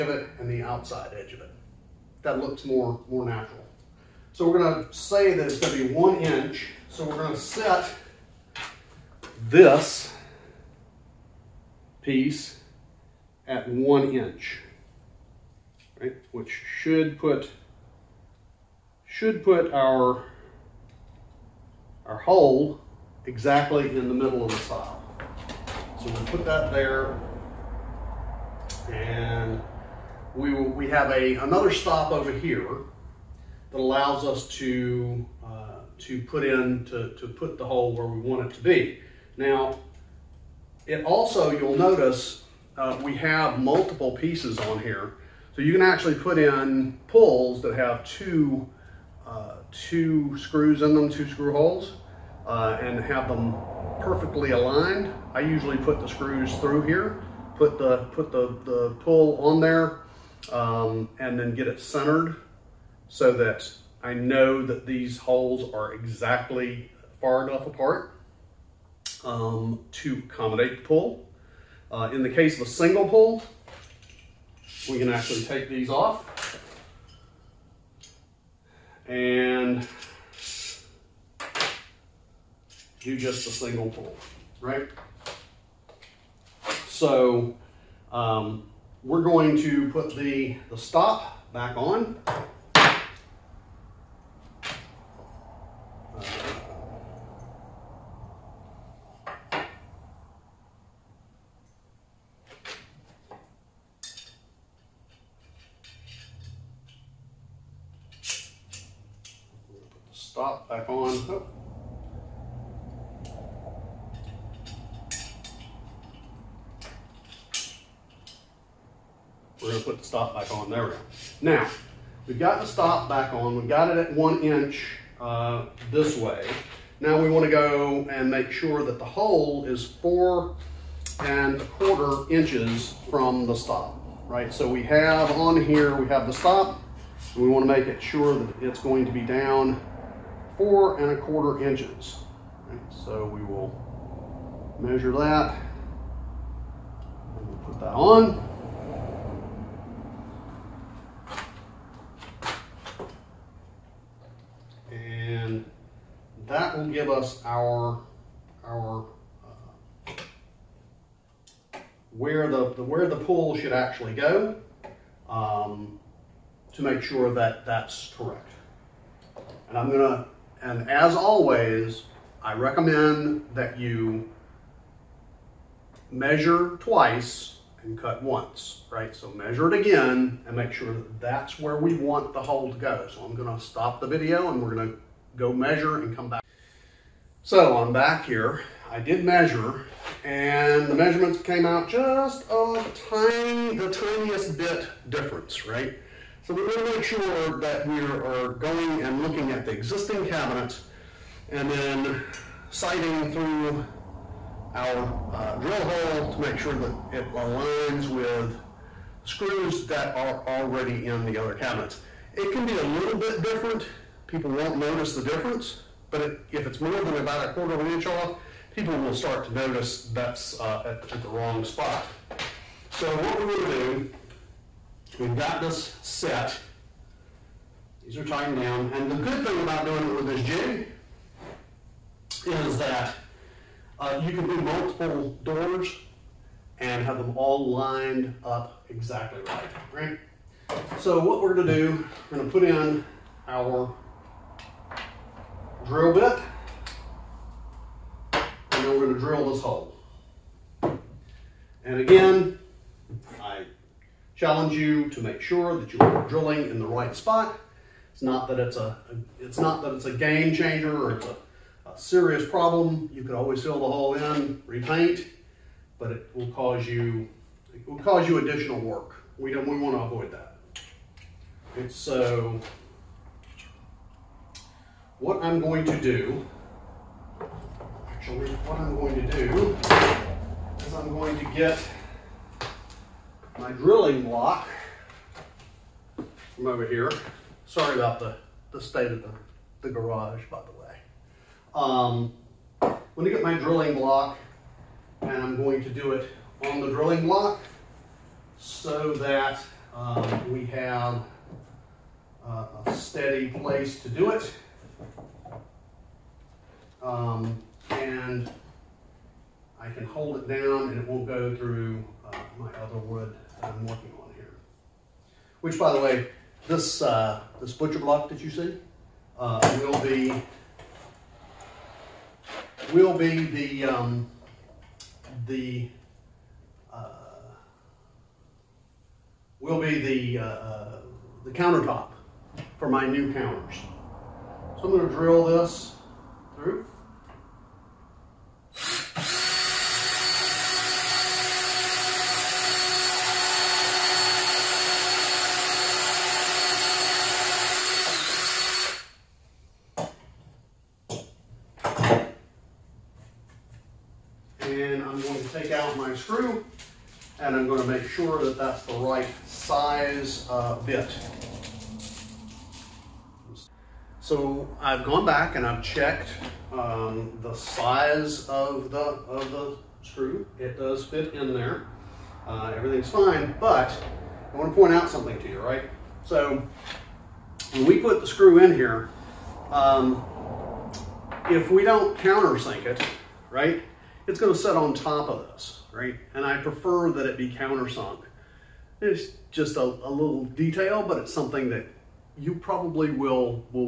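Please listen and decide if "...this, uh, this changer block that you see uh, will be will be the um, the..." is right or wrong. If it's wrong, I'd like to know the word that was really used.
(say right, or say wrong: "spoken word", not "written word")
wrong: "butcher", not "changer".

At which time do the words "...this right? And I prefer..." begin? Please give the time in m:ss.
6:25.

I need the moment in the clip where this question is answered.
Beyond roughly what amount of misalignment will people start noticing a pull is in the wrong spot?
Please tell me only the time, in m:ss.
3:37.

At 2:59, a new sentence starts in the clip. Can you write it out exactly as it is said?
So measure it again and make sure that that's where we want the hole to go.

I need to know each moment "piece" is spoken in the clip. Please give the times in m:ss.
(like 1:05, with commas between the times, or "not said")
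0:12, 0:44.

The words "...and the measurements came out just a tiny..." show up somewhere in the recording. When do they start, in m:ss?
3:10.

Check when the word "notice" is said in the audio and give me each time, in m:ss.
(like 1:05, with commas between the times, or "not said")
0:41, 3:34, 3:39.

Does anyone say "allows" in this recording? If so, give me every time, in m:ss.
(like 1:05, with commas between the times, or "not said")
0:33.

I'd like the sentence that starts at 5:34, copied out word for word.
So I'm going to drill this through.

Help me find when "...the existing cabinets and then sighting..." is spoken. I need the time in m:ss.
3:19.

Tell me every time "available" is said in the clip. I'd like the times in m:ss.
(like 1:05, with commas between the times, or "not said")
not said.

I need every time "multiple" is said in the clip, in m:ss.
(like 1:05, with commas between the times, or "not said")
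0:43, 3:54.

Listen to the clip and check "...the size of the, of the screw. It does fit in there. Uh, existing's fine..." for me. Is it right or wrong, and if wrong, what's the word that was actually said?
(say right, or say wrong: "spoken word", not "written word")
wrong: "everything", not "existing".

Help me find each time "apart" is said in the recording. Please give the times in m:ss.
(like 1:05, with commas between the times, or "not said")
1:07.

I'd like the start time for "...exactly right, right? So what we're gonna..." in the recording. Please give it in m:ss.
3:58.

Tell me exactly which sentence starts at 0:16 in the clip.
Which should put should put our our hole exactly in the middle of the stile.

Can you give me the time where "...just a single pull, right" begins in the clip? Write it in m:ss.
1:23.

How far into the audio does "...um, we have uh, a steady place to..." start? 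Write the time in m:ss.
4:59.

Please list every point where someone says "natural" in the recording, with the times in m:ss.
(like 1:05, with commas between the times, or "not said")
0:03.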